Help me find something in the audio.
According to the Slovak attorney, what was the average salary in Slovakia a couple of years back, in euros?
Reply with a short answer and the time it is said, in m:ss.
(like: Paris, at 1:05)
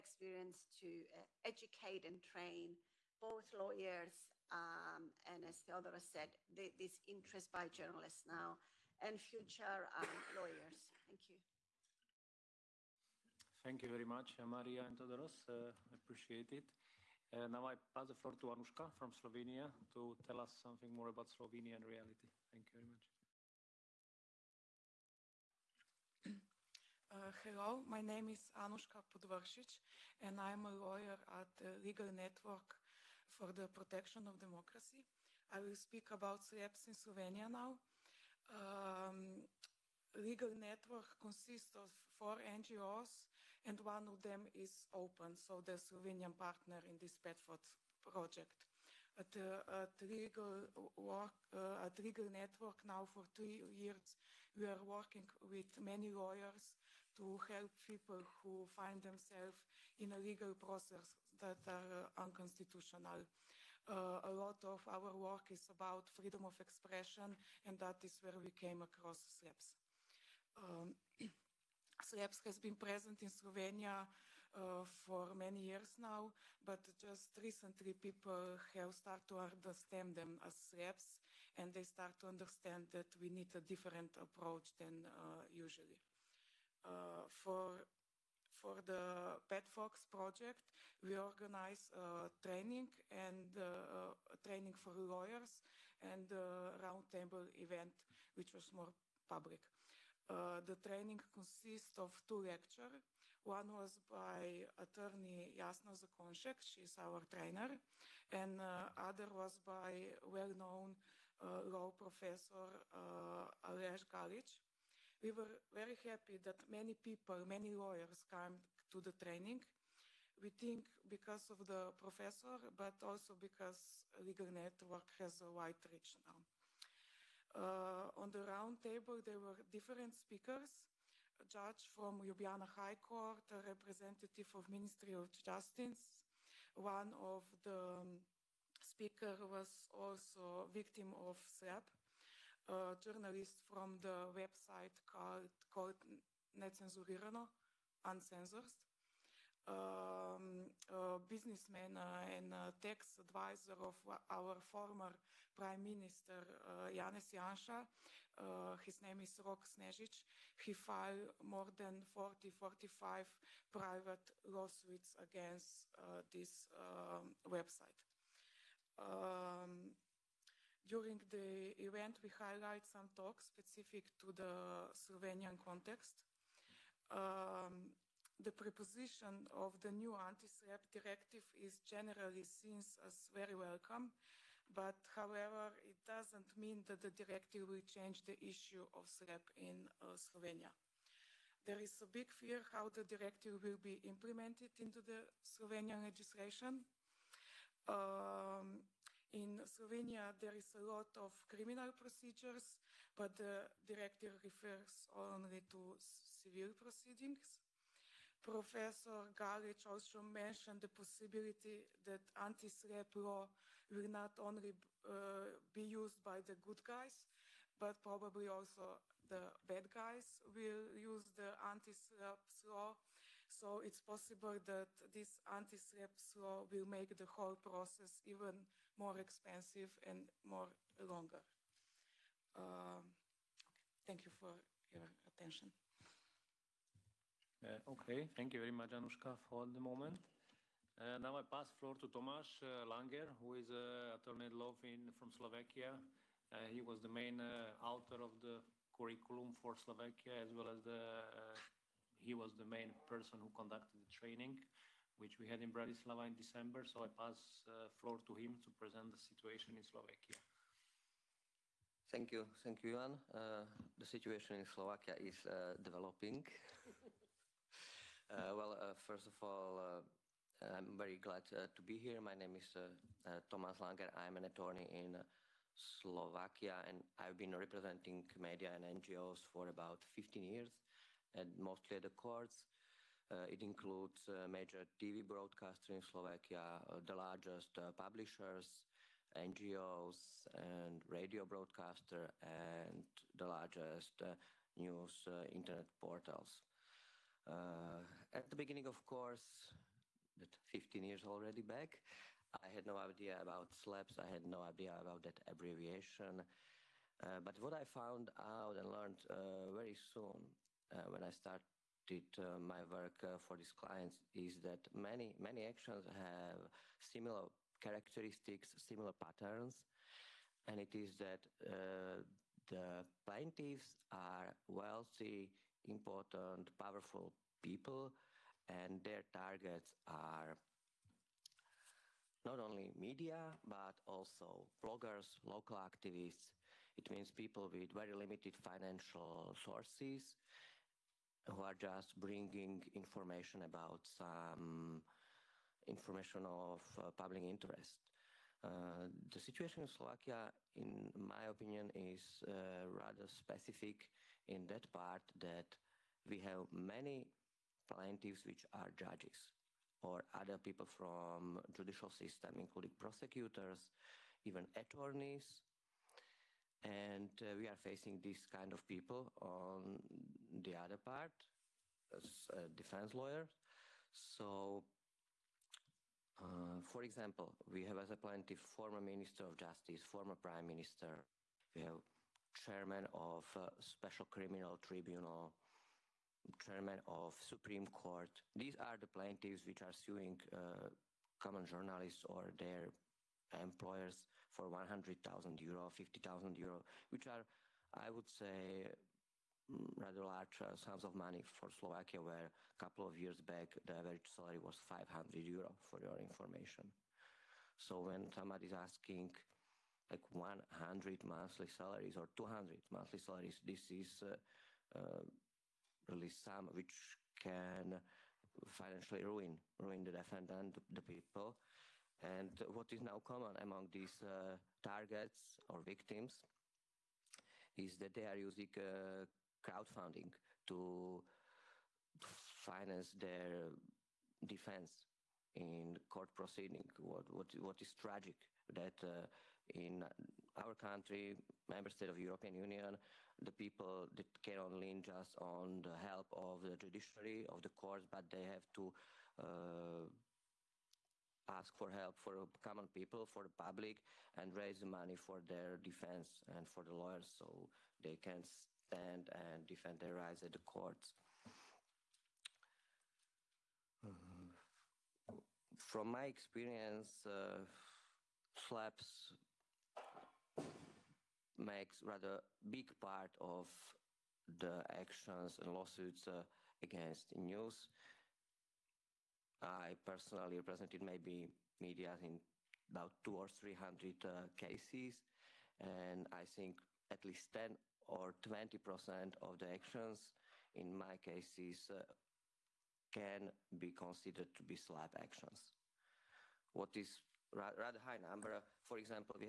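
500 euro, at 6:44.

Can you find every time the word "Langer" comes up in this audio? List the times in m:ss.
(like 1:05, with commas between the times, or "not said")
4:02, 4:33.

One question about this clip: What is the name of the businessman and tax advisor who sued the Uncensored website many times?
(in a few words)
Rok Snežić.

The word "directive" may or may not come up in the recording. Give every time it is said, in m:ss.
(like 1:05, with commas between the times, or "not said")
3:00, 3:07, 3:13, 3:23.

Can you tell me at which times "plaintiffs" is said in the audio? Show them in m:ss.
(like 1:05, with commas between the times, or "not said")
5:23, 5:57, 6:18, 6:29.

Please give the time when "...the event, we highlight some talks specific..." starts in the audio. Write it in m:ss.
2:51.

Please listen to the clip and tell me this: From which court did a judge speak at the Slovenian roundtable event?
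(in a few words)
Ljubljana High Court.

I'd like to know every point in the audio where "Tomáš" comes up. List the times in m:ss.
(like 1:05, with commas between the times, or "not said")
4:02, 4:32.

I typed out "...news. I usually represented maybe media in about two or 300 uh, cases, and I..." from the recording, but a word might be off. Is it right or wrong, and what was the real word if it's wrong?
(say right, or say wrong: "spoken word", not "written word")
wrong: "personally", not "usually".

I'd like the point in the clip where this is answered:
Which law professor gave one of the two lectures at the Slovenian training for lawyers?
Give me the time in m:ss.
1:53.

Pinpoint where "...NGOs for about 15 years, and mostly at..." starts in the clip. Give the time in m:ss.
4:38.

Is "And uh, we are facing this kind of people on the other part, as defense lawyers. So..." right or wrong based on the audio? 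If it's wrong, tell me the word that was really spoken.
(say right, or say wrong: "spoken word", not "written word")
right.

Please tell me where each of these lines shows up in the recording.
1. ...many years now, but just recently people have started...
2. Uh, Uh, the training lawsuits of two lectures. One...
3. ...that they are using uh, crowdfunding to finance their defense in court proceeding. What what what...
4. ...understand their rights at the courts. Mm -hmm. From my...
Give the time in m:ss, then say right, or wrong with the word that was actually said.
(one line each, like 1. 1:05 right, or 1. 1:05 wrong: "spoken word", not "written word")
1. 1:15 right
2. 1:39 wrong: "consists", not "lawsuits"
3. 7:07 right
4. 7:39 wrong: "defend", not "understand".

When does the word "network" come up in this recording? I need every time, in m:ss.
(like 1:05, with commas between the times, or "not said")
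0:32, 0:40, 0:52, 2:04.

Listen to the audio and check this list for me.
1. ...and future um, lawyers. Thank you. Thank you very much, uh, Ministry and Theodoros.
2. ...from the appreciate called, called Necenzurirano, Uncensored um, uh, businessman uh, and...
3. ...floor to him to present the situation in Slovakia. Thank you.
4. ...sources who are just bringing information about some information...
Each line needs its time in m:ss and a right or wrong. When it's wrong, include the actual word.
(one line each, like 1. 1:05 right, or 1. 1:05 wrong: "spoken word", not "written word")
1. 0:08 wrong: "Maria", not "Ministry"
2. 2:23 wrong: "website", not "appreciate"
3. 4:17 right
4. 5:39 right.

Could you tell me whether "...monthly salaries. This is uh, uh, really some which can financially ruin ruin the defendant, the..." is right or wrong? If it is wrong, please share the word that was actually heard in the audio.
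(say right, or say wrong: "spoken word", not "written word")
right.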